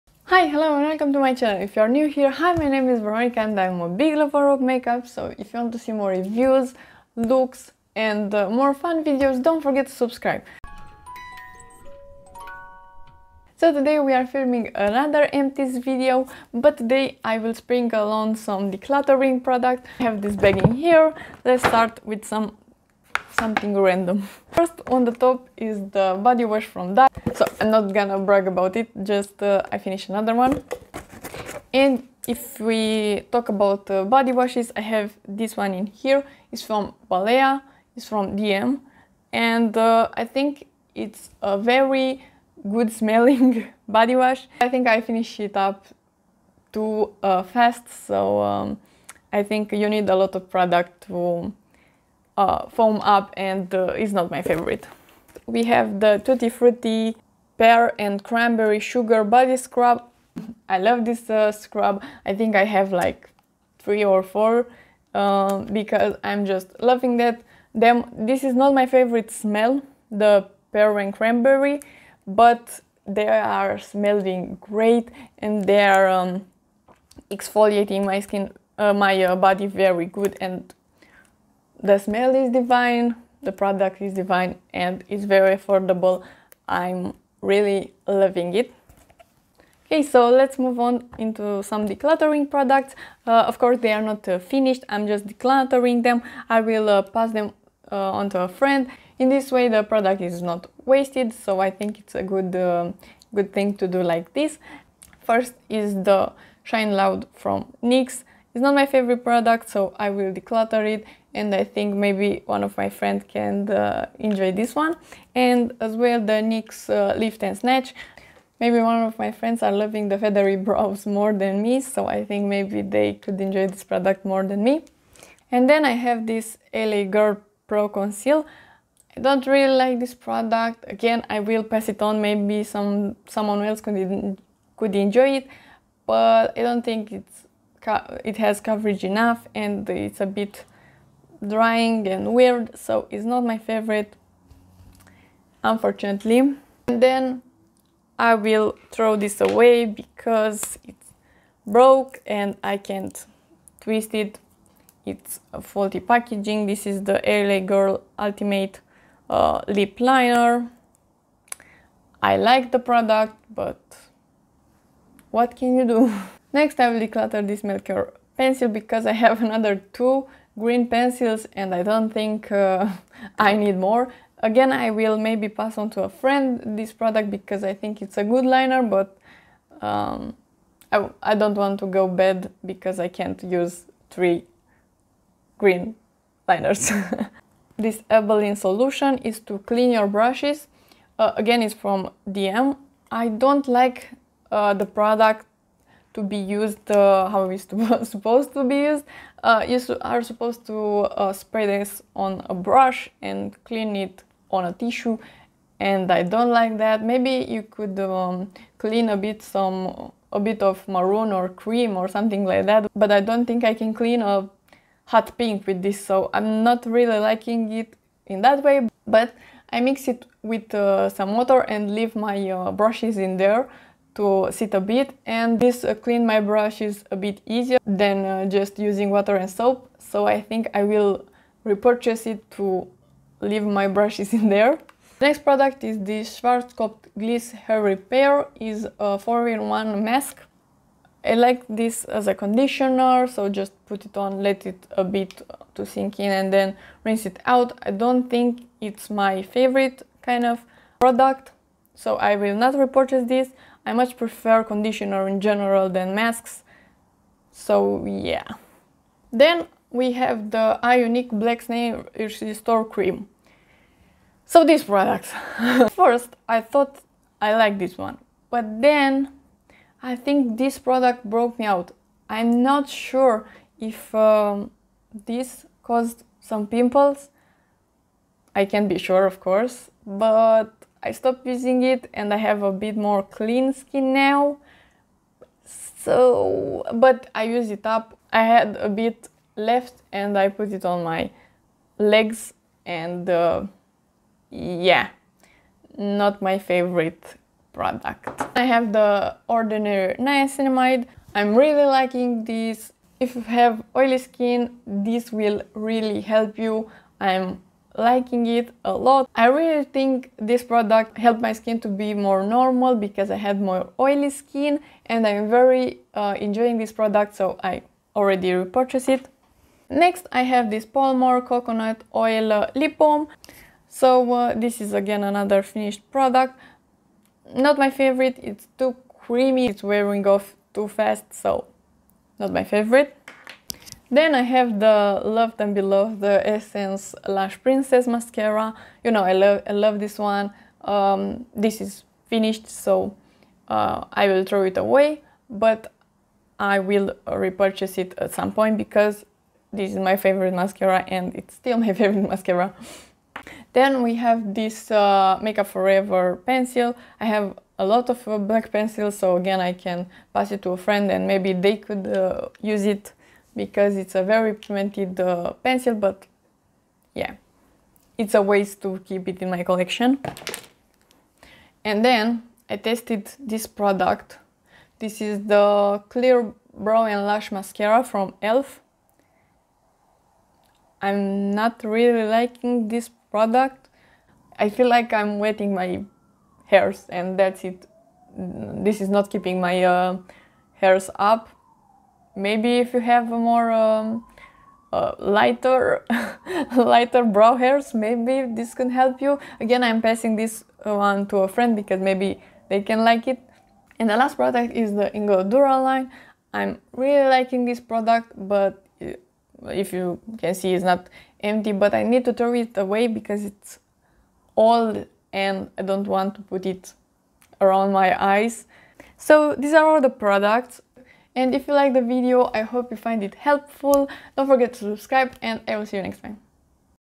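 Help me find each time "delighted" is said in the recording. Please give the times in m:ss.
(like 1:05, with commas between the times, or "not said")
not said.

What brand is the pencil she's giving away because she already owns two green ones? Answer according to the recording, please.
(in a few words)
Melkior.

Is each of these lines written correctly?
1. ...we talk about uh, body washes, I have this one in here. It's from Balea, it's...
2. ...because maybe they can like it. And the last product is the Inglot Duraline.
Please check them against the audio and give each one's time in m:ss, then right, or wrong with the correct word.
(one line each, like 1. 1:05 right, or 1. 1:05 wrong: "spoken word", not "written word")
1. 0:32 right
2. 6:41 right.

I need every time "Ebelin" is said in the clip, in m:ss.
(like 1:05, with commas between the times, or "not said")
3:08.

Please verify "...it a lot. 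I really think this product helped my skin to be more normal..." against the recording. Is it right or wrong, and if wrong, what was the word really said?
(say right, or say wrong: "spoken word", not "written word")
right.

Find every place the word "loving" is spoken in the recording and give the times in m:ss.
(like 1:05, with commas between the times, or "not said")
1:06, 1:28, 1:59.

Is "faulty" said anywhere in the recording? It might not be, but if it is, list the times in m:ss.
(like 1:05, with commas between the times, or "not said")
2:35.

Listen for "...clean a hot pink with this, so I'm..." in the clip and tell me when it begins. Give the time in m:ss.
3:33.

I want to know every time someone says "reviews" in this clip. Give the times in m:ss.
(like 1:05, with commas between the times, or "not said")
0:06.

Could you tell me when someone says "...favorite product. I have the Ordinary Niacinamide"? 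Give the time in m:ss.
4:56.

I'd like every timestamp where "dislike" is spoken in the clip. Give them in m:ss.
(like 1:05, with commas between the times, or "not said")
not said.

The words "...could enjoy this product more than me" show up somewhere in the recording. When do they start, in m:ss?
2:03.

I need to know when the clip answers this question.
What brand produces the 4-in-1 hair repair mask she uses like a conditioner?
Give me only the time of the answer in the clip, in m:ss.
3:56.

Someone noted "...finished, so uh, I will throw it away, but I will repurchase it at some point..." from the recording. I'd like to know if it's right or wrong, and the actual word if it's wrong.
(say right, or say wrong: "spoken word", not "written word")
right.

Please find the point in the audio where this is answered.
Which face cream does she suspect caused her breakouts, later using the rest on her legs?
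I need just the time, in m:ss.
4:20.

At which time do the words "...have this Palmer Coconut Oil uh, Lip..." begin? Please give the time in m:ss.
5:20.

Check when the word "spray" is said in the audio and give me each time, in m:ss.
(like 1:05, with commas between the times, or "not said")
3:21.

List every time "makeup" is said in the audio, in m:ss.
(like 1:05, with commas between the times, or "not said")
0:04, 5:55.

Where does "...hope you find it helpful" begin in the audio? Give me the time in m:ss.
7:02.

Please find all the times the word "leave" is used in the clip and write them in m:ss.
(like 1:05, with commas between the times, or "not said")
3:41, 3:53.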